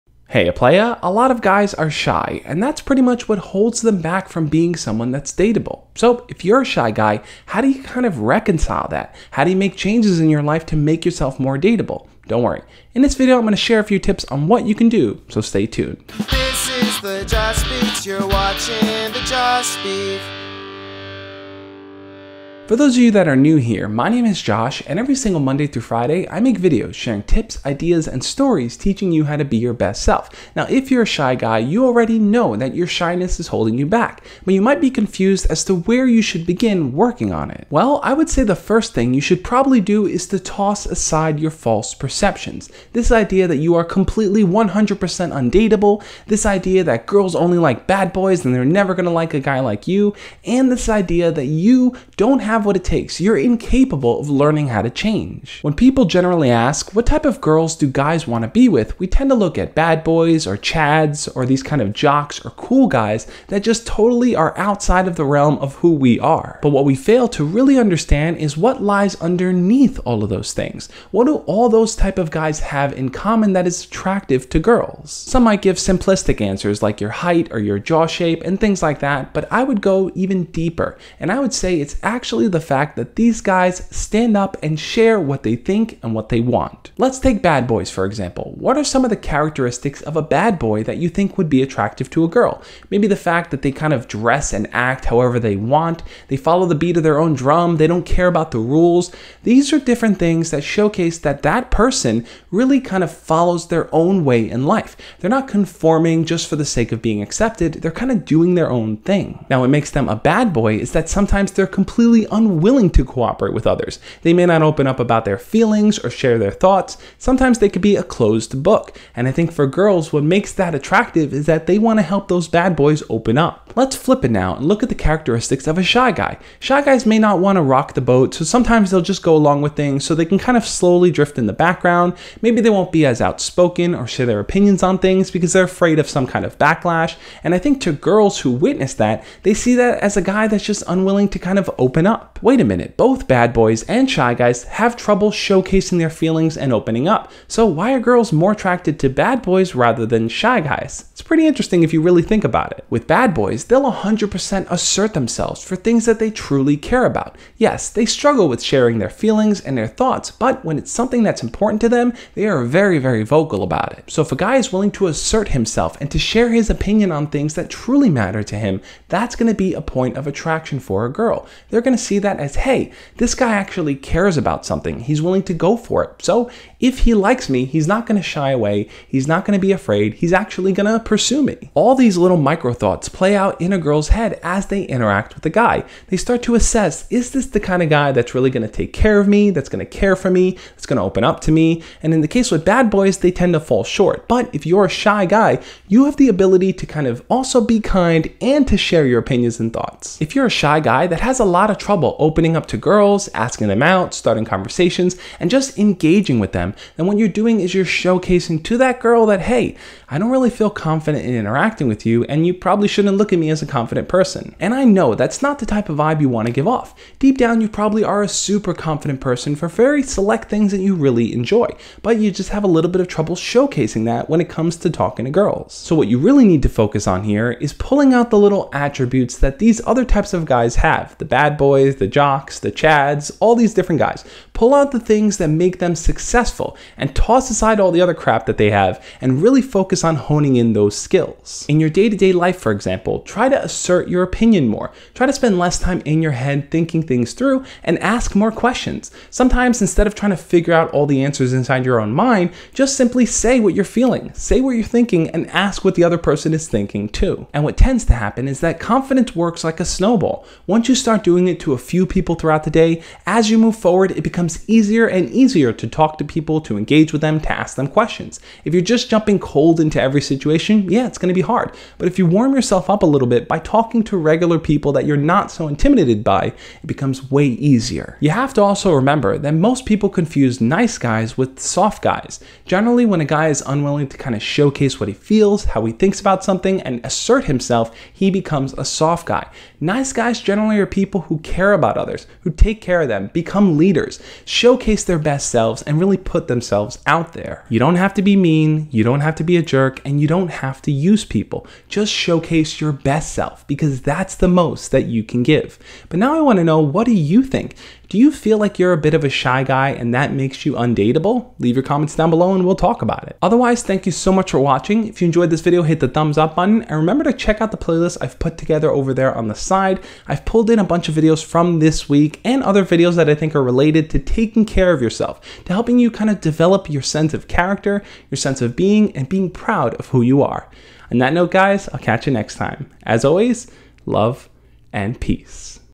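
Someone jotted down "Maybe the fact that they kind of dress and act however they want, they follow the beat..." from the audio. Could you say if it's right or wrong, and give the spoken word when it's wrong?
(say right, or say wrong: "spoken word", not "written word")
right.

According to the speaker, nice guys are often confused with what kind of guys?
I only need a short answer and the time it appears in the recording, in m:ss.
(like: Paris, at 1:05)
soft guys, at 4:41.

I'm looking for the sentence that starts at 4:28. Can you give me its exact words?
If you're just jumping cold into every situation, yeah, it's gonna be hard.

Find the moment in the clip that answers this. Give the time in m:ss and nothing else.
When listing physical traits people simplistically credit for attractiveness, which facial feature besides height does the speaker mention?
1:17.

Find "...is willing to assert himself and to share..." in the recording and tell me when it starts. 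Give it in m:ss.
2:44.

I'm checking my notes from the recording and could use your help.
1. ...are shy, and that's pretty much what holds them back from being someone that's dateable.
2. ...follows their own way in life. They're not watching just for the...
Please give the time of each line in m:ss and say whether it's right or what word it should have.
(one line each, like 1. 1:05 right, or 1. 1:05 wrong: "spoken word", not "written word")
1. 0:01 right
2. 1:43 wrong: "conforming", not "watching".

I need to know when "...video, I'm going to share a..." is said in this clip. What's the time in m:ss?
0:13.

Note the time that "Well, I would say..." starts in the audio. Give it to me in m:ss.
0:37.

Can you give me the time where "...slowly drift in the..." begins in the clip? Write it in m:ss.
2:10.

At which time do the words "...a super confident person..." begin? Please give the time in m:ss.
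3:38.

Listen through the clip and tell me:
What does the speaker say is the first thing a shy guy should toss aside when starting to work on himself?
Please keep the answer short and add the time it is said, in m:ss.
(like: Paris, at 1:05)
false perceptions, at 0:41.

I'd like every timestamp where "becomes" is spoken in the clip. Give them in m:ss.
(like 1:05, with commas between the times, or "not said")
4:24, 4:36, 4:48, 4:53.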